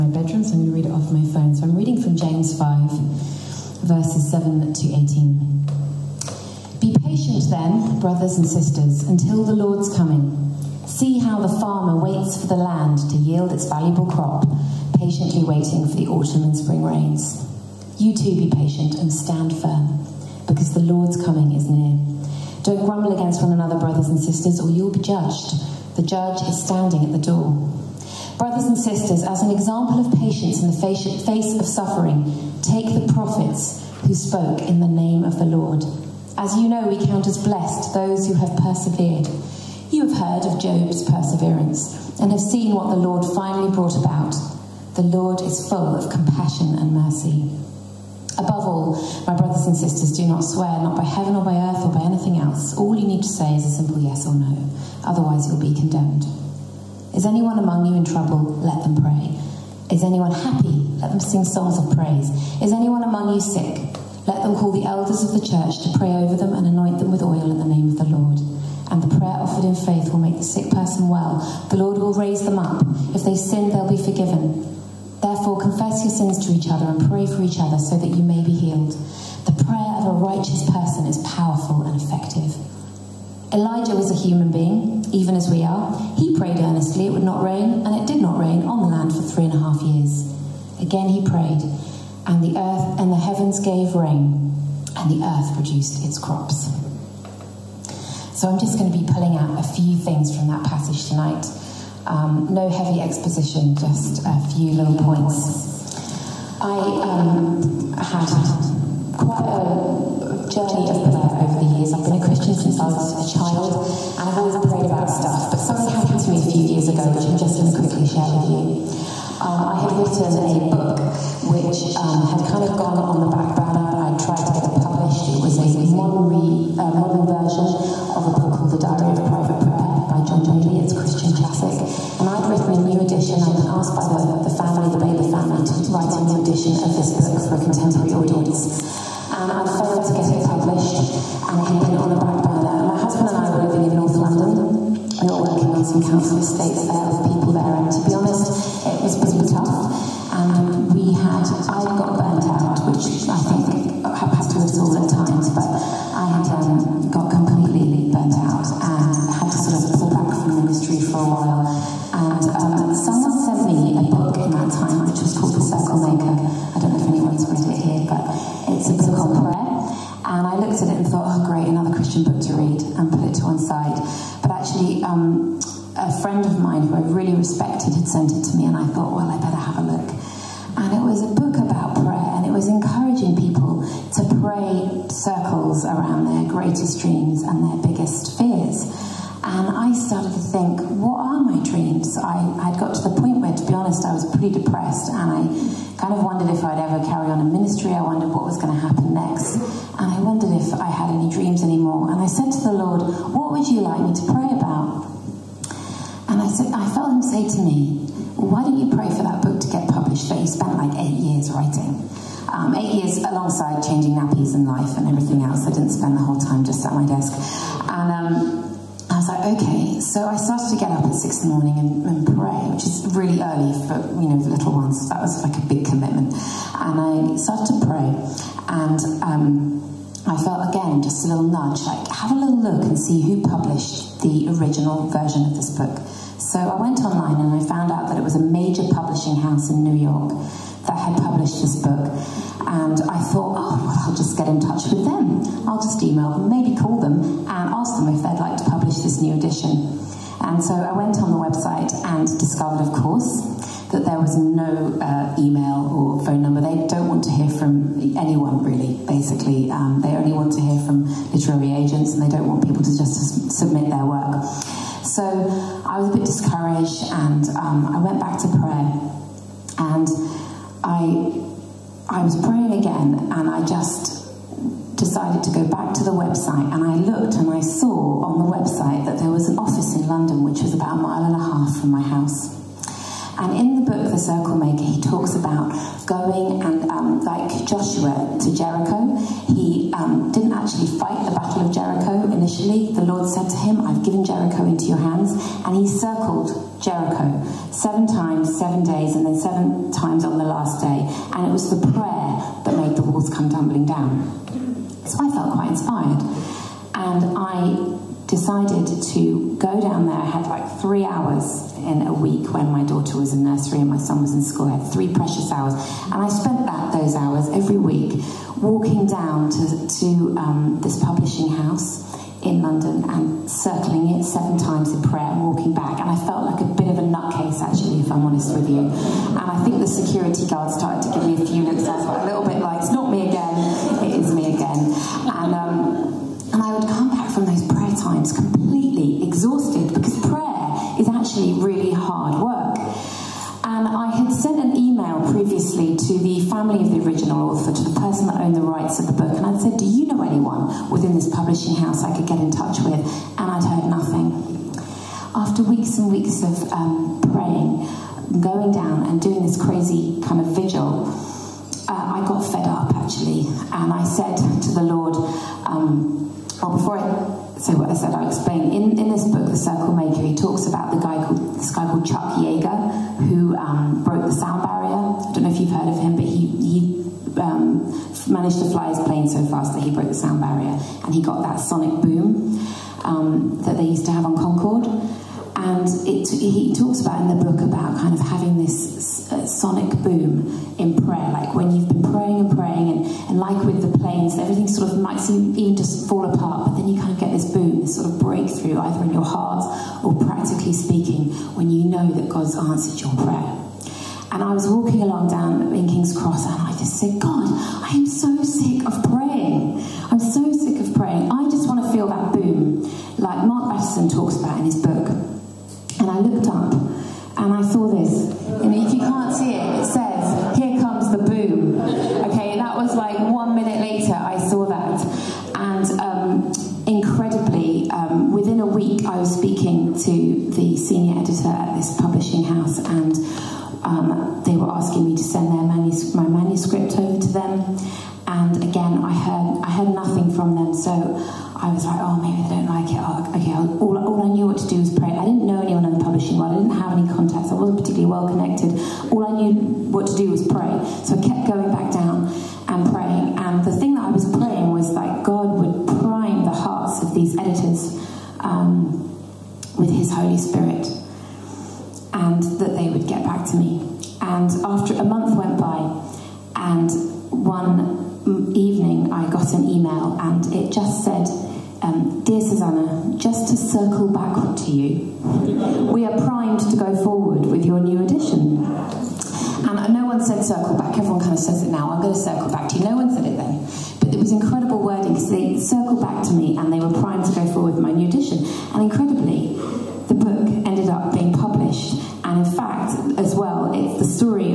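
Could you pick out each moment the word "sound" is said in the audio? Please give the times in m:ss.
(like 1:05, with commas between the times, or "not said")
6:14, 6:20.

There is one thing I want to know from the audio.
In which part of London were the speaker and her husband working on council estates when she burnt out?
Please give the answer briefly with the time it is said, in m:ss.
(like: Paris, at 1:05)
North London, at 2:23.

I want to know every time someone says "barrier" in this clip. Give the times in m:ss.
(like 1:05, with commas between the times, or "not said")
6:14, 6:20.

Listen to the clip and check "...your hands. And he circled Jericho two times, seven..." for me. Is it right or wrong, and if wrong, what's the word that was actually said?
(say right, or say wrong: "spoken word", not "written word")
wrong: "seven", not "two".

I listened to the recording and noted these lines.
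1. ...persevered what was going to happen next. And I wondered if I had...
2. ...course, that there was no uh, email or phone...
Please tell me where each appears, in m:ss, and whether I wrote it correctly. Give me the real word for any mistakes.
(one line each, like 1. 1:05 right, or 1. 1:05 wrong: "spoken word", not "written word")
1. 3:18 wrong: "wondered", not "persevered"
2. 4:12 right.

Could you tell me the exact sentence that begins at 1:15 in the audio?
Therefore, confess your sins to each other and pray for each other so that you may be healed.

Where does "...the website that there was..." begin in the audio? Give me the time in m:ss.
4:38.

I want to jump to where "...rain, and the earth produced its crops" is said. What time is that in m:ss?
1:33.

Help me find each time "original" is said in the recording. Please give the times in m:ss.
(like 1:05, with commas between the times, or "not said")
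3:54, 5:47.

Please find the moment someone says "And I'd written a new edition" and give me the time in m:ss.
2:12.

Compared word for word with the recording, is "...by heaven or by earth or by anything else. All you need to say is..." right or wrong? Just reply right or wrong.
right.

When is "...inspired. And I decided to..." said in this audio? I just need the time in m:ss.
5:05.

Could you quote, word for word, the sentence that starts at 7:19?
I heard, I heard nothing from them.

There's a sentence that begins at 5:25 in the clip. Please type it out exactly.
And I felt like a bit of a nutcase, actually, if I'm honest with you.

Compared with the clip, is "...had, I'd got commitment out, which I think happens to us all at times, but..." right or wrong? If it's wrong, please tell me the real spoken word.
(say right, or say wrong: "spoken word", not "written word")
wrong: "burnt", not "commitment".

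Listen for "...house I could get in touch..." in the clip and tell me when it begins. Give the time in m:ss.
5:51.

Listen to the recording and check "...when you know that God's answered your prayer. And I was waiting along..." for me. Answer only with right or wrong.
wrong.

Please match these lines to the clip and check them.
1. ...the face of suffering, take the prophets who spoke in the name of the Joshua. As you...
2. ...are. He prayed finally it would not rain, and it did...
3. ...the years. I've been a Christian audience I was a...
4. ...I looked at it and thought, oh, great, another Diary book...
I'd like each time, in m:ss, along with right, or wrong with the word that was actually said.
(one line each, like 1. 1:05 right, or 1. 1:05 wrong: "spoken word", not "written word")
1. 0:30 wrong: "Lord", not "Joshua"
2. 1:25 wrong: "earnestly", not "finally"
3. 1:51 wrong: "since", not "audience"
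4. 2:50 wrong: "Christian", not "Diary".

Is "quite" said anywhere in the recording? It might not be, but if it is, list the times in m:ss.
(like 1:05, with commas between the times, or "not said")
1:49, 5:05.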